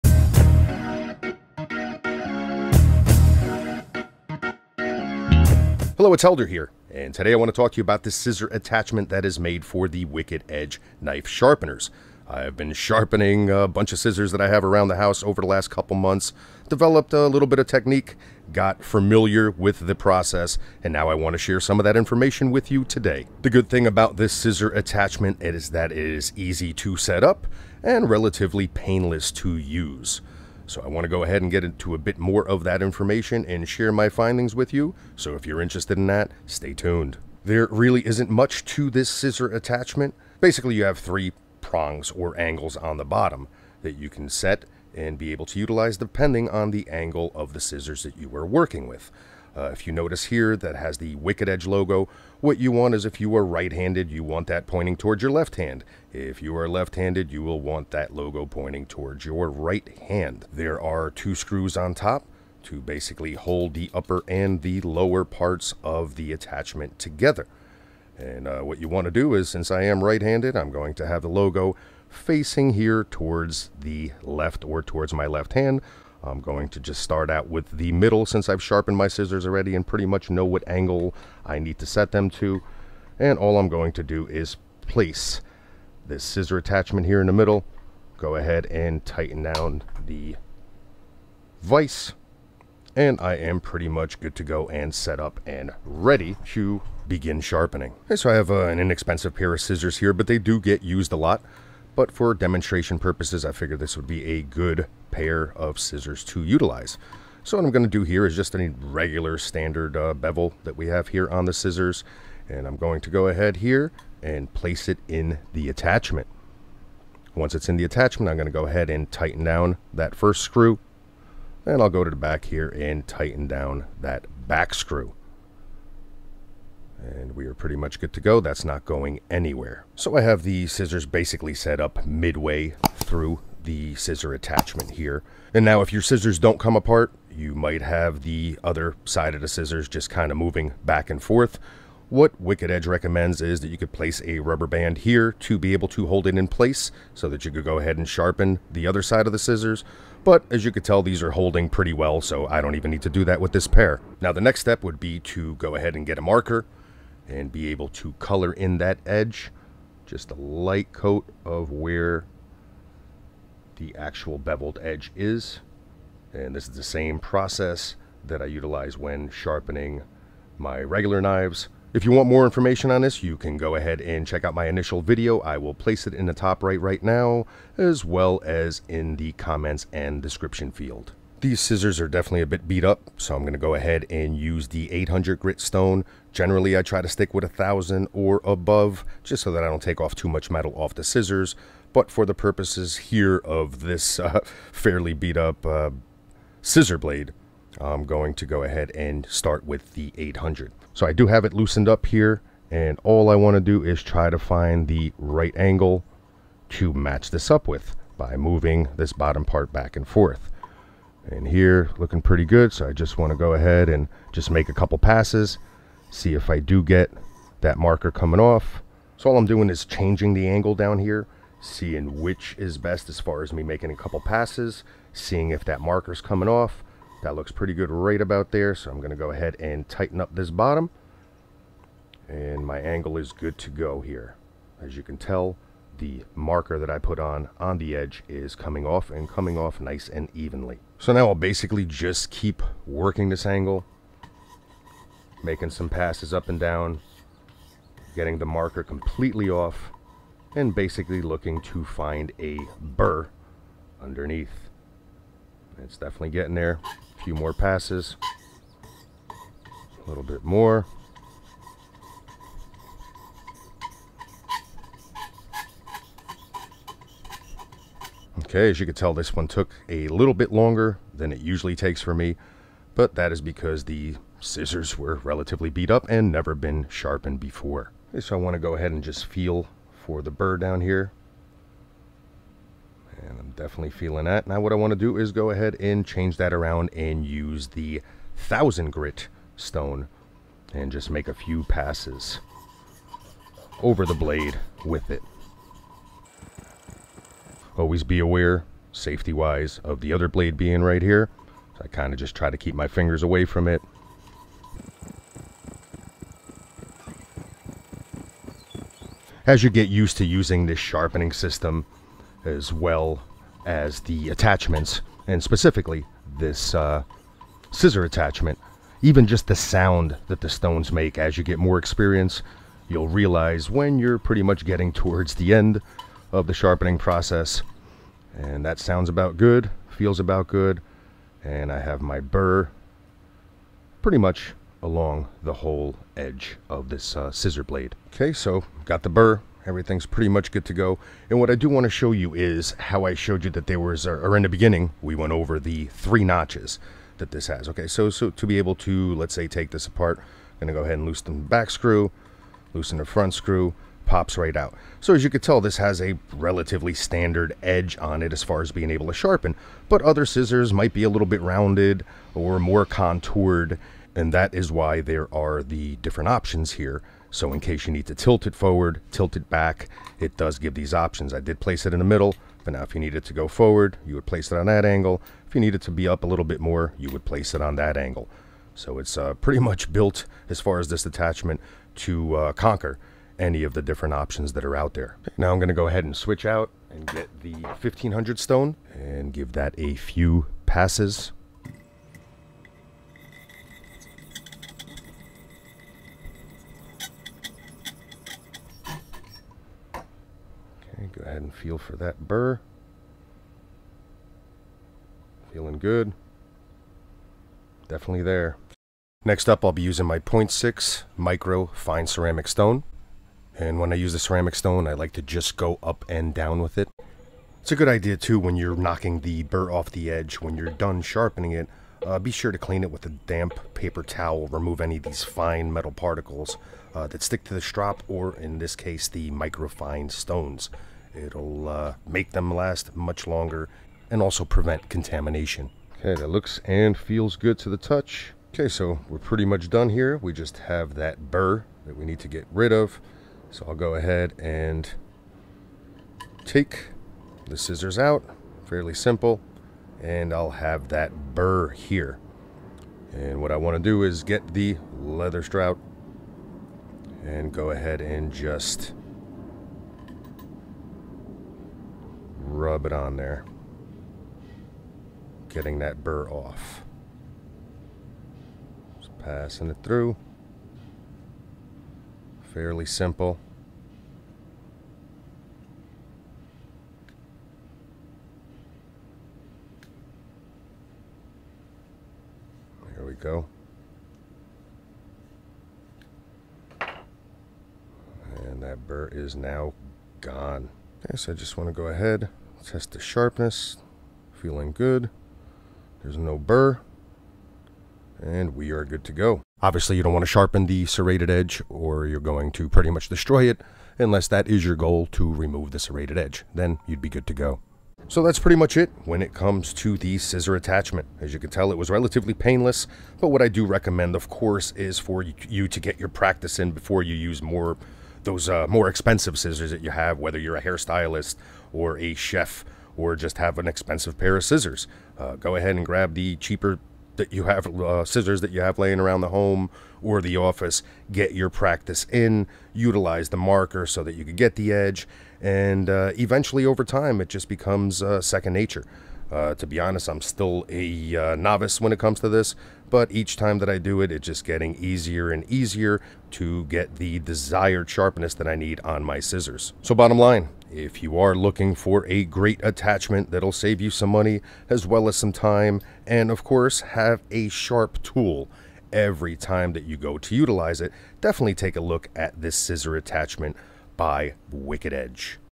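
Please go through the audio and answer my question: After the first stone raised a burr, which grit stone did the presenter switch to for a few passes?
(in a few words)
1000.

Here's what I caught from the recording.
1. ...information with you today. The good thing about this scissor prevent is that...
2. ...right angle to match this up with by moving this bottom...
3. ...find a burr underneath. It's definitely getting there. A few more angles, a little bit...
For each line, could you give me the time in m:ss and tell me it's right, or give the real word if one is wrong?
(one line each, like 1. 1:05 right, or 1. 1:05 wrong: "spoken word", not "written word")
1. 0:21 wrong: "attachment", not "prevent"
2. 3:25 right
3. 4:11 wrong: "passes", not "angles".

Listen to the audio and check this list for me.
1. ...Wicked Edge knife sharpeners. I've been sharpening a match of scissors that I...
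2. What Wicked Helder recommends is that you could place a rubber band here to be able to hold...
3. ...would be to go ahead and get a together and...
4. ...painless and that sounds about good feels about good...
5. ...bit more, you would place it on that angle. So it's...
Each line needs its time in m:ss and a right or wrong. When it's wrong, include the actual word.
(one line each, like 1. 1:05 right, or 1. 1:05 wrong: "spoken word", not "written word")
1. 0:10 wrong: "bunch", not "match"
2. 2:22 wrong: "Edge", not "Helder"
3. 2:34 wrong: "marker", not "together"
4. 5:26 wrong: "process", not "painless"
5. 6:16 right.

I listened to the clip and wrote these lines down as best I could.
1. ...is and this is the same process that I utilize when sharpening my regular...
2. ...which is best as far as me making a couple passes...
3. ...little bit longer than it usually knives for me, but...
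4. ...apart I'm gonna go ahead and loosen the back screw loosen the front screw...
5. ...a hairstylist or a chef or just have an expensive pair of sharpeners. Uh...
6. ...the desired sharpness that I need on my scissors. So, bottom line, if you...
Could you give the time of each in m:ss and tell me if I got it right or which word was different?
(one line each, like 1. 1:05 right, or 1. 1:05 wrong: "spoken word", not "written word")
1. 2:45 right
2. 3:42 right
3. 4:30 wrong: "takes", not "knives"
4. 5:49 right
5. 8:40 wrong: "scissors", not "sharpeners"
6. 9:06 right.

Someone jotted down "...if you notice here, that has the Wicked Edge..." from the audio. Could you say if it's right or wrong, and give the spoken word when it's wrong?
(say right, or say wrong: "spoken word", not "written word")
right.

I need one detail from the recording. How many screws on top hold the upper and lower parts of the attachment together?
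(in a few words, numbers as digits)
2.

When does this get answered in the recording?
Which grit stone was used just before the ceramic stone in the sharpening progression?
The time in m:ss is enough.
6:27.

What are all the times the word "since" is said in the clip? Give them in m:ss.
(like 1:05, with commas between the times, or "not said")
1:09, 1:18.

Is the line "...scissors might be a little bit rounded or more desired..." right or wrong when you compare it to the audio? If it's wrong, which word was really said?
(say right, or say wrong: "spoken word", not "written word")
wrong: "contoured", not "desired".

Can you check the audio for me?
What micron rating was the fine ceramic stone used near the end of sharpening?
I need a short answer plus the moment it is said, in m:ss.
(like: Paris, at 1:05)
0.6, at 6:50.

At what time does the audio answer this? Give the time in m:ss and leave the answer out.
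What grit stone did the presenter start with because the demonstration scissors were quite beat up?
3:04.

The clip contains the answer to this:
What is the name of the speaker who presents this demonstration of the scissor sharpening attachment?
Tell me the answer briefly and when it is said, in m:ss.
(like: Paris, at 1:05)
Helder, at 0:06.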